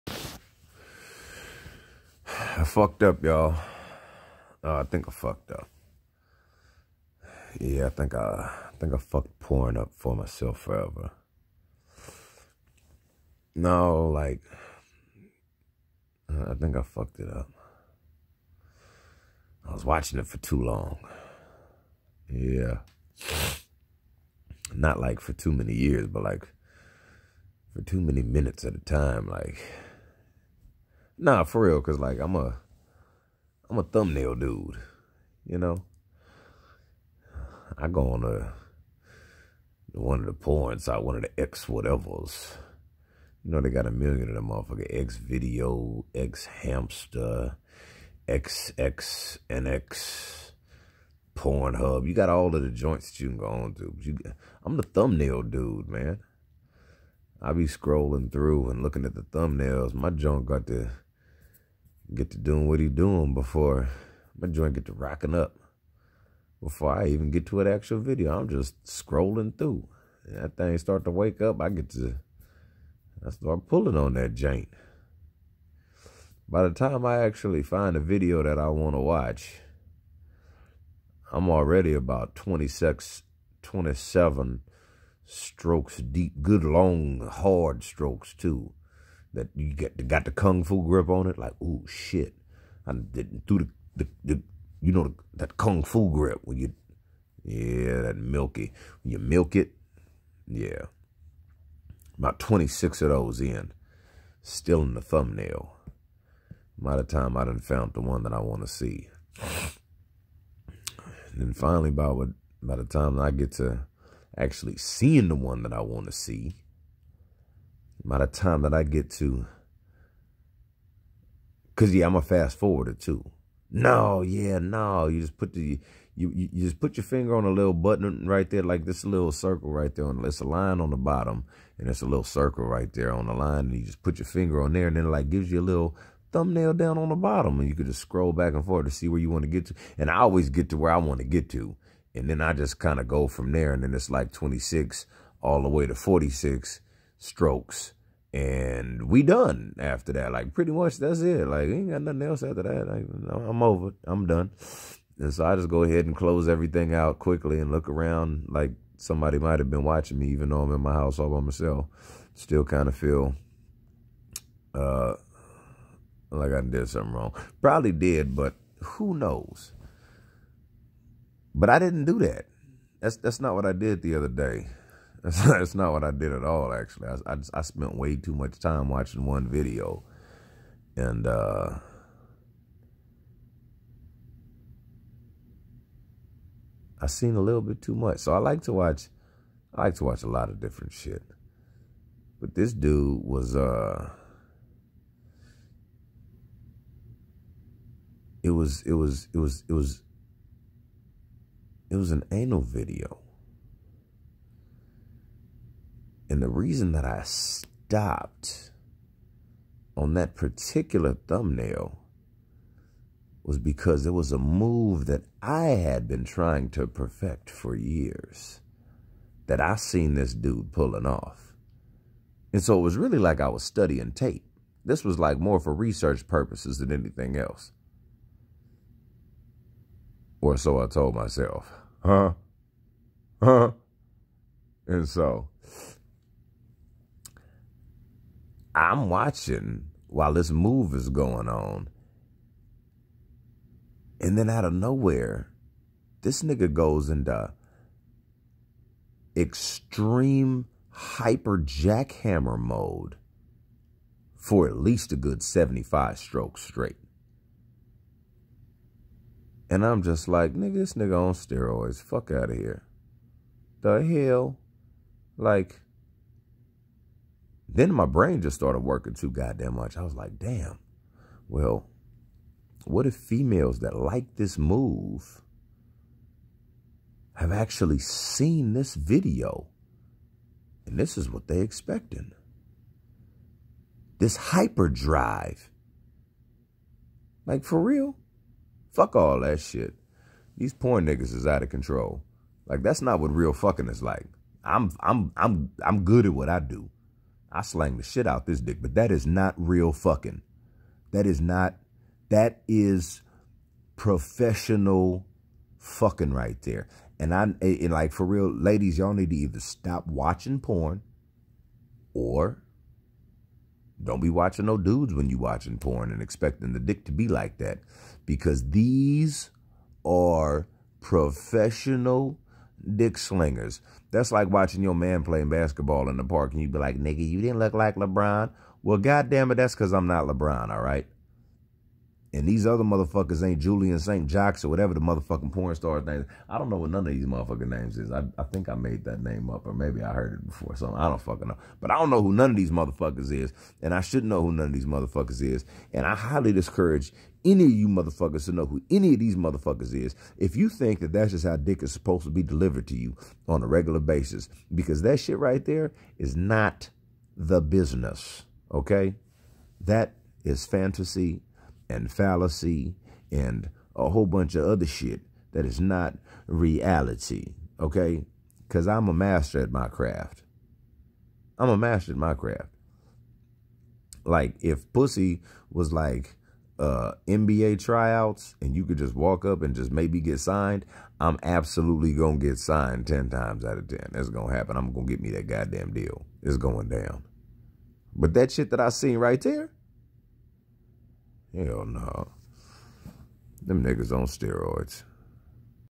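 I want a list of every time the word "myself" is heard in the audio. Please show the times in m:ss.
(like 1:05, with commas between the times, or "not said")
0:10, 2:41, 3:51.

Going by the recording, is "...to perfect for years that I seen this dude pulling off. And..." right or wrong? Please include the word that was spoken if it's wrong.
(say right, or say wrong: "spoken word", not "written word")
right.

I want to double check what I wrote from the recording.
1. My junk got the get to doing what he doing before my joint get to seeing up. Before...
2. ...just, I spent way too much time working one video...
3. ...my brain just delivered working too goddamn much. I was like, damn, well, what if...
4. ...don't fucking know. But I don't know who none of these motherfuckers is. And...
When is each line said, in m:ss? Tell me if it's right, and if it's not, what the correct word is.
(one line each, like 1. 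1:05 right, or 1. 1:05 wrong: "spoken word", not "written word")
1. 0:59 wrong: "rocking", not "seeing"
2. 2:57 wrong: "watching", not "working"
3. 4:27 wrong: "started", not "delivered"
4. 5:41 right.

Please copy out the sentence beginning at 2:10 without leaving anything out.
On, it's a line on the bottom, and it's a little circle right there on the line.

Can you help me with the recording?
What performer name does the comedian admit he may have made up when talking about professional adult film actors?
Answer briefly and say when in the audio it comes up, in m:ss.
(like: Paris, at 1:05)
Julian St. Jox, at 5:33.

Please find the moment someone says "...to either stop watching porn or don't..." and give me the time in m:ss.
5:09.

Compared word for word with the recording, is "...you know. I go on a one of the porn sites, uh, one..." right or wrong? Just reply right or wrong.
right.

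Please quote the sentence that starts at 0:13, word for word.
No, like, I think I fucked it up.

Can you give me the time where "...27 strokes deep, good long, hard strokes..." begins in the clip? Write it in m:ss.
1:23.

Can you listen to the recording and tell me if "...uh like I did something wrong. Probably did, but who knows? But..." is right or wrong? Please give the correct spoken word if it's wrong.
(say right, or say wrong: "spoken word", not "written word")
right.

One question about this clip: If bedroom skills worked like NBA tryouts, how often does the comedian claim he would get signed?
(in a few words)
10 times out of 10.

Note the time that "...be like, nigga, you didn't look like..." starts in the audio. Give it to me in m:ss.
5:26.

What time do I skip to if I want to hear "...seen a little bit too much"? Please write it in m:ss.
3:07.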